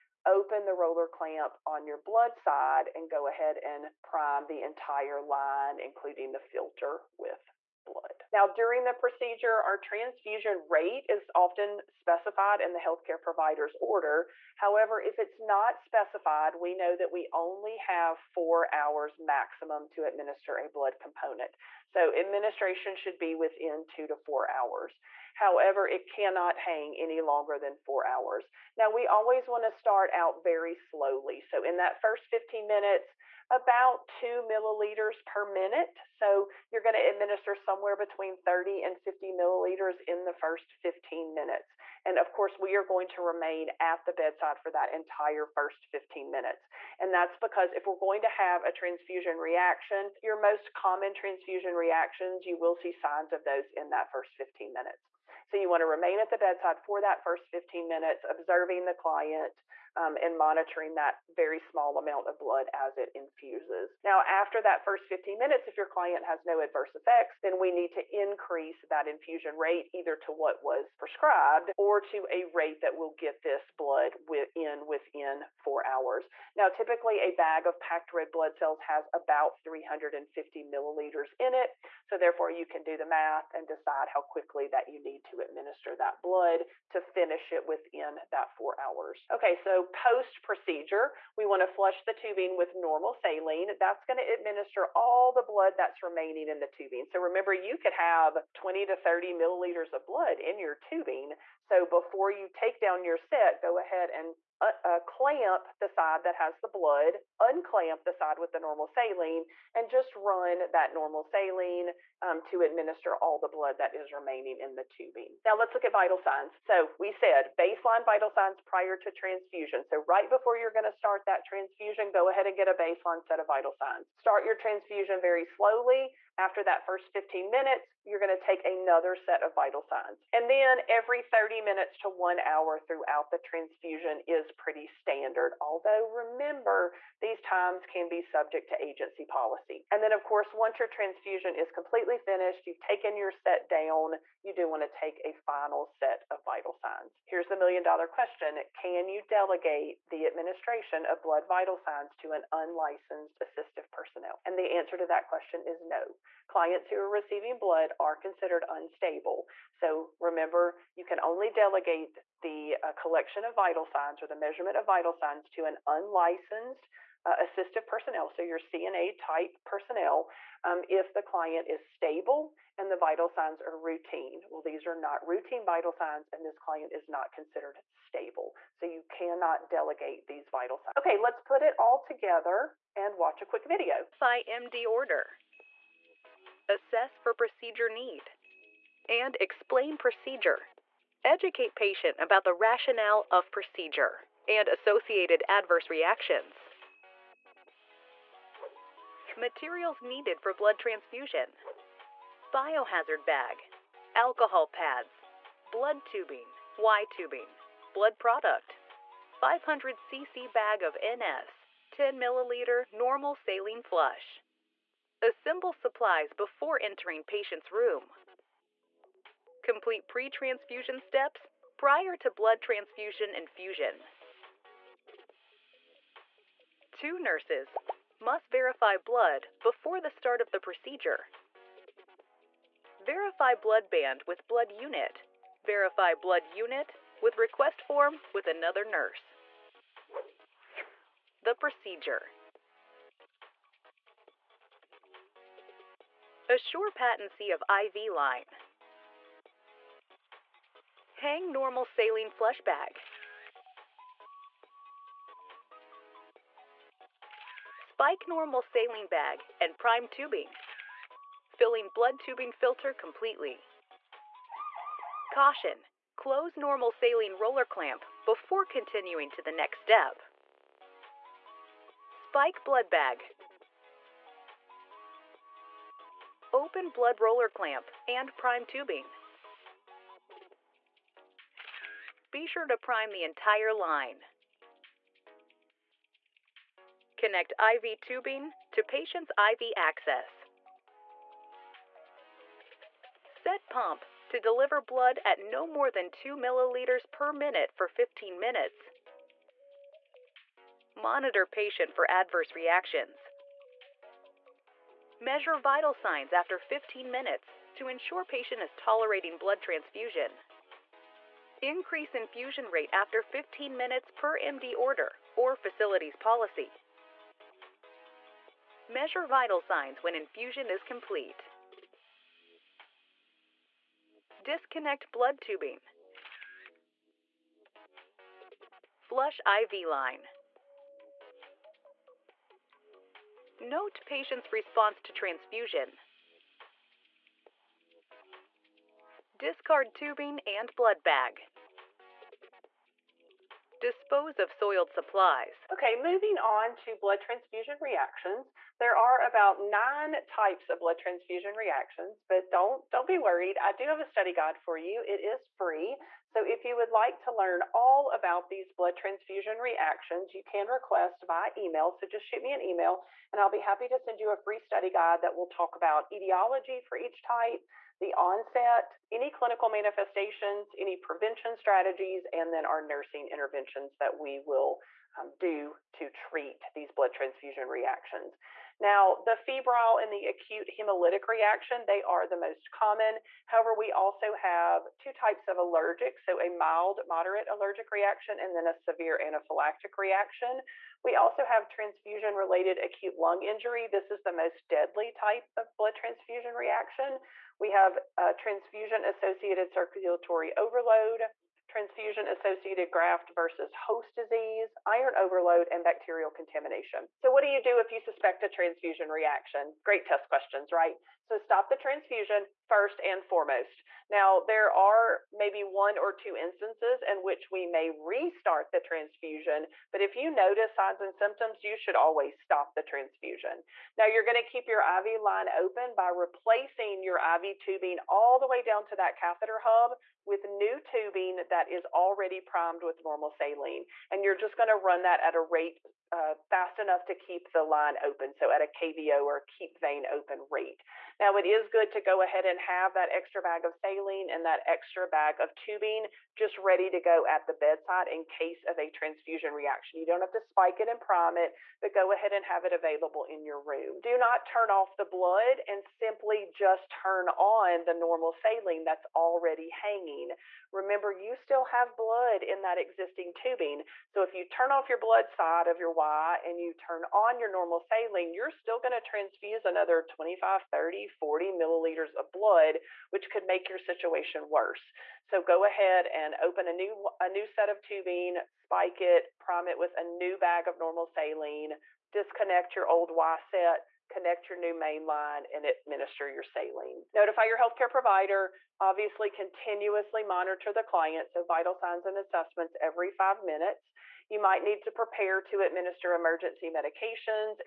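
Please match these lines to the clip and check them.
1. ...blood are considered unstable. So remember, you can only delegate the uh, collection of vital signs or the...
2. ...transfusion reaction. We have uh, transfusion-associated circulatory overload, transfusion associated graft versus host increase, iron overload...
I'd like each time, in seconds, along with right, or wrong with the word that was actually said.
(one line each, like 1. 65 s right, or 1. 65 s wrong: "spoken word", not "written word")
1. 157 s right
2. 395 s wrong: "disease", not "increase".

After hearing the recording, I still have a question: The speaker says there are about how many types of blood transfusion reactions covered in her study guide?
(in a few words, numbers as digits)
9.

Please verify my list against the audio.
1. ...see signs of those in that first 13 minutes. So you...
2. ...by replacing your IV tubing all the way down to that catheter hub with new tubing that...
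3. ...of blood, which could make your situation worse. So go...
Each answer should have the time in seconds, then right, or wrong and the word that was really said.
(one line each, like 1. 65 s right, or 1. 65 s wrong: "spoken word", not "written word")
1. 52 s wrong: "15", not "13"
2. 425 s right
3. 472 s right.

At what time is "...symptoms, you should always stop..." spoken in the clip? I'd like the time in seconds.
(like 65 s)
421 s.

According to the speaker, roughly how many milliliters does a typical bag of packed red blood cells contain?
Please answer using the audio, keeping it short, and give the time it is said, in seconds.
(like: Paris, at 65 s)
350 milliliters, at 79 s.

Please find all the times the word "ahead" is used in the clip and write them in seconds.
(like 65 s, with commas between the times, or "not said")
3 s, 103 s, 122 s, 442 s, 452 s, 475 s.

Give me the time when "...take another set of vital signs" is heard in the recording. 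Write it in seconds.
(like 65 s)
128 s.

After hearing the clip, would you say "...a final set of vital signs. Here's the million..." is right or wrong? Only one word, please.
right.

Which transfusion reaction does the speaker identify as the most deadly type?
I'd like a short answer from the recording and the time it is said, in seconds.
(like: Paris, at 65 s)
transfusion-related acute lung injury, at 391 s.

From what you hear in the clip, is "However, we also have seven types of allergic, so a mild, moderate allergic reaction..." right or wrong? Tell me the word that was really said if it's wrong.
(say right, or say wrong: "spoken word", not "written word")
wrong: "two", not "seven".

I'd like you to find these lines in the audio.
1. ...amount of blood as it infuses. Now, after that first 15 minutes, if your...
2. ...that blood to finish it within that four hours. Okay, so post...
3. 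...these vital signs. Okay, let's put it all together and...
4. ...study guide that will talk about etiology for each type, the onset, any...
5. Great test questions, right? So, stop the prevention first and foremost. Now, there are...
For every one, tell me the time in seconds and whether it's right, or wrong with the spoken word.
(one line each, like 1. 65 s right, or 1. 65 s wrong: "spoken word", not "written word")
1. 61 s right
2. 85 s right
3. 180 s right
4. 364 s right
5. 409 s wrong: "transfusion", not "prevention".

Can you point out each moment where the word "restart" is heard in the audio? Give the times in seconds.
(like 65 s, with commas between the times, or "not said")
417 s.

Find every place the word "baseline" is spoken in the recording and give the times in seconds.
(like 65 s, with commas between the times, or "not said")
117 s, 122 s.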